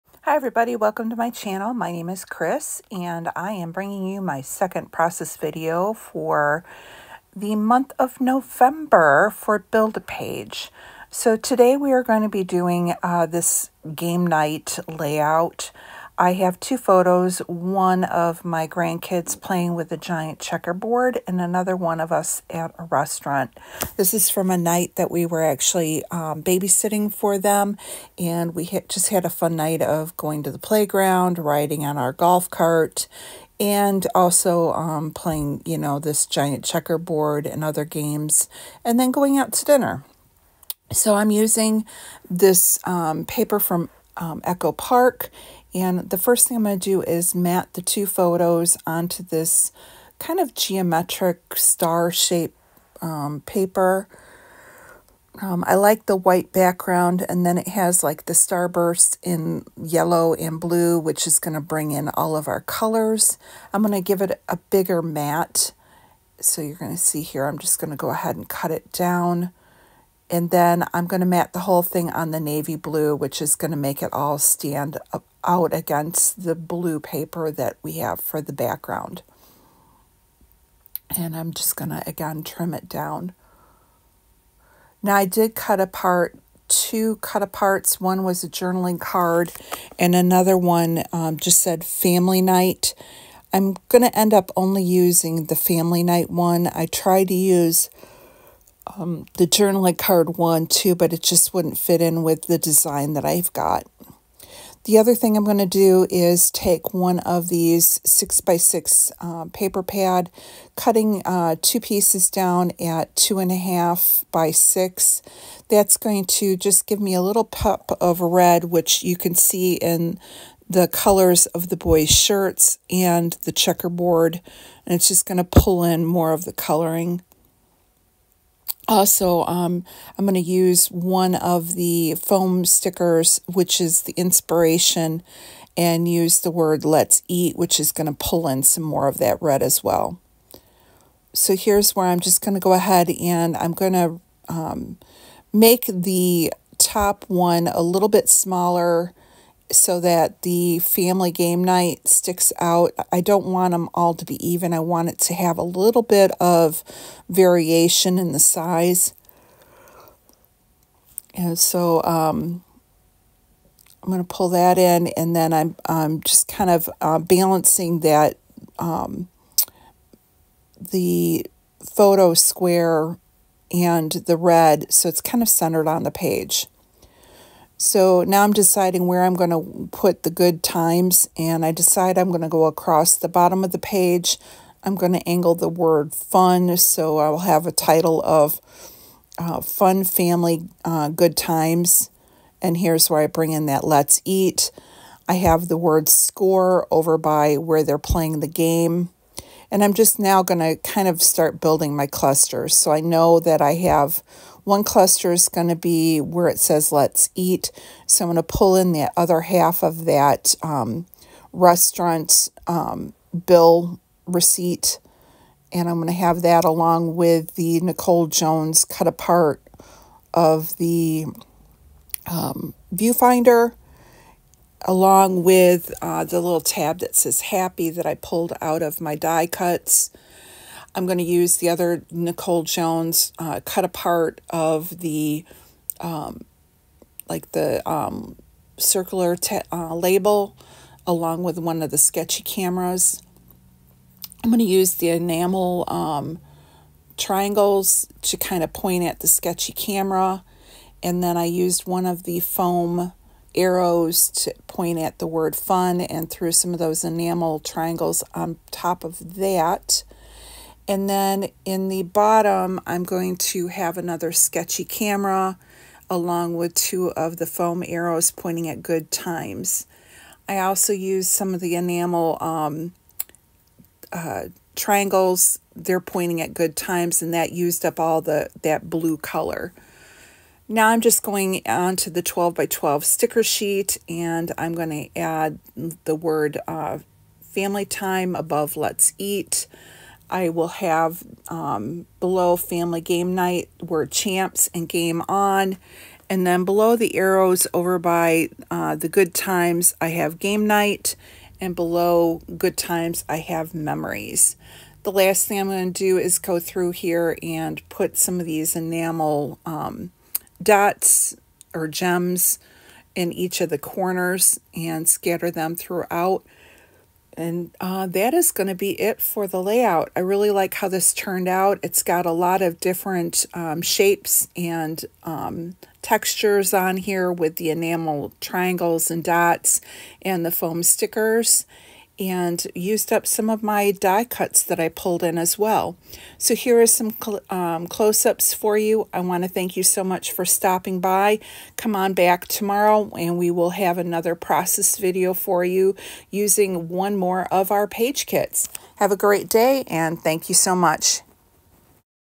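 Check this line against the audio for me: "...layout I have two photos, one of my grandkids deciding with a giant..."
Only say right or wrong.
wrong.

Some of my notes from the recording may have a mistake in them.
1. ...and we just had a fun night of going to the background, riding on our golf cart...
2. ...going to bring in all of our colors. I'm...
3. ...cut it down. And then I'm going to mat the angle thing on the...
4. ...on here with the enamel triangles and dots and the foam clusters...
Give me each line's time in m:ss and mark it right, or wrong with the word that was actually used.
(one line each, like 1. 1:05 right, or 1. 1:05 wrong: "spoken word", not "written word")
1. 0:28 wrong: "playground", not "background"
2. 1:01 right
3. 1:08 wrong: "whole", not "angle"
4. 5:26 wrong: "stickers", not "clusters".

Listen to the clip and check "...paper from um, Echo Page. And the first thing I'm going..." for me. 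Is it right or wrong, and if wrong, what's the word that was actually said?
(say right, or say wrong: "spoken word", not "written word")
wrong: "Park", not "Page".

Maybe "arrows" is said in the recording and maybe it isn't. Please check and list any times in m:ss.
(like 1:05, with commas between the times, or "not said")
4:13, 4:27, 4:57.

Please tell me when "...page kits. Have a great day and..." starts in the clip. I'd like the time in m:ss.
5:47.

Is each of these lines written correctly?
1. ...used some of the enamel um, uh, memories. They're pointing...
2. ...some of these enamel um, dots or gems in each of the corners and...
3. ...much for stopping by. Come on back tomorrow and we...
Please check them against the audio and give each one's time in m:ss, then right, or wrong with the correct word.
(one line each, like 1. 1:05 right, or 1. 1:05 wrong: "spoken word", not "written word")
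1. 4:30 wrong: "triangles", not "memories"
2. 5:08 right
3. 5:40 right.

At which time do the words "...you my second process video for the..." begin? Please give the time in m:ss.
0:04.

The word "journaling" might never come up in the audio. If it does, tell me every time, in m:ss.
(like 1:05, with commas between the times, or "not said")
1:28, 1:39.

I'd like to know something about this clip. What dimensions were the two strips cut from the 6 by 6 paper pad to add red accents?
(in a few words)
2.5 by 6.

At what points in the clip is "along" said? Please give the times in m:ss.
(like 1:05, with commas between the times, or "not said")
3:36, 3:44, 4:01, 4:26.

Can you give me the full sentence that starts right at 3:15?
I have the word score over by where they're playing the game.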